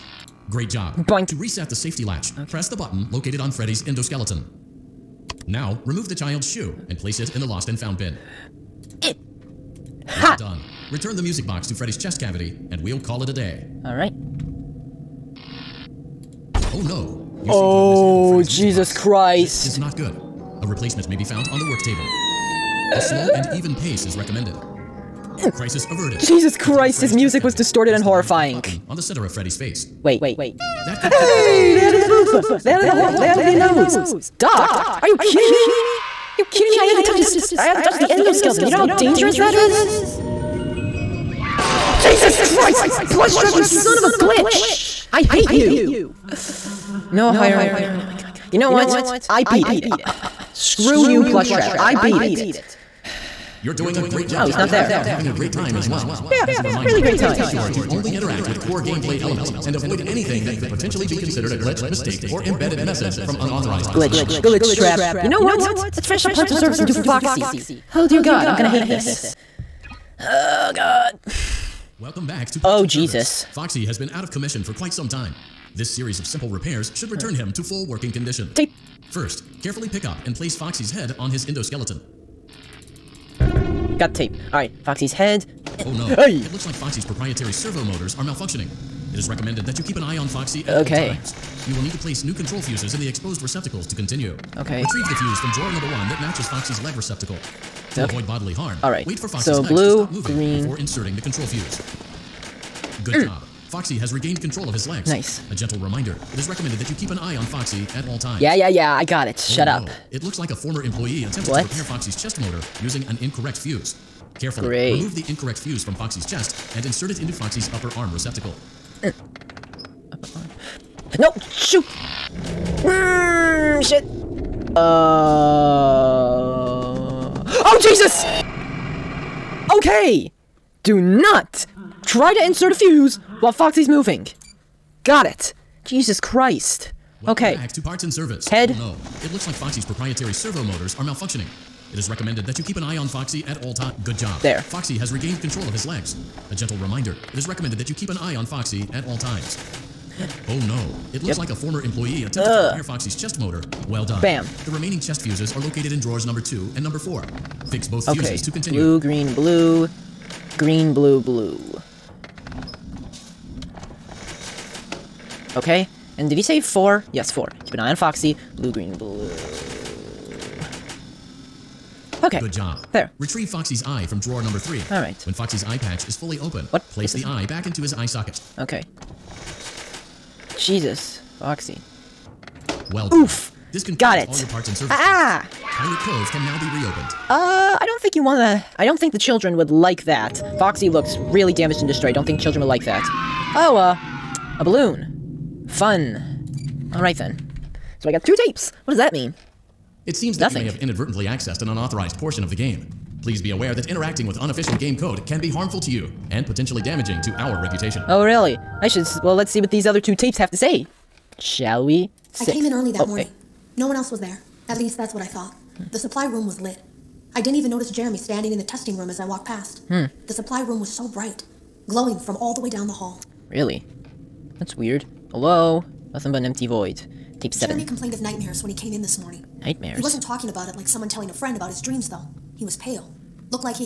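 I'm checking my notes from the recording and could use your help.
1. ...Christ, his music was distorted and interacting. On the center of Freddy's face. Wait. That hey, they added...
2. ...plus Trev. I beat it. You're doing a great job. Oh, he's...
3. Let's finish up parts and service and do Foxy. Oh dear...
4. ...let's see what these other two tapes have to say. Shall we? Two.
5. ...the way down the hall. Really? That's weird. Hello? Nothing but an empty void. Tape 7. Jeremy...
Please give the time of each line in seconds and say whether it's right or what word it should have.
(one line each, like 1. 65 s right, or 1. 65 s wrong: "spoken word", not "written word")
1. 26 s wrong: "horrifying", not "interacting"
2. 51 s right
3. 65 s right
4. 209 s wrong: "Six", not "Two"
5. 222 s right.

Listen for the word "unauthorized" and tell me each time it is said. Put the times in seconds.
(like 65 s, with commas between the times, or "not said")
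63 s, 201 s.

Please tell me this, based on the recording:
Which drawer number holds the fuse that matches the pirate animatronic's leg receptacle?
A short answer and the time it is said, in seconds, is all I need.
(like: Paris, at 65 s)
1, at 95 s.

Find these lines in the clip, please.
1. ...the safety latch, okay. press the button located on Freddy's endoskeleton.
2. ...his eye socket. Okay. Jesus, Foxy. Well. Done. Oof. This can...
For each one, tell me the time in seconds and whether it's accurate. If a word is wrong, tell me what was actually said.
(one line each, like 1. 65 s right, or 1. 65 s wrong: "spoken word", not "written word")
1. 1 s right
2. 177 s right.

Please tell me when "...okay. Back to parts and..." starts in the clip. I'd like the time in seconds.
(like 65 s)
137 s.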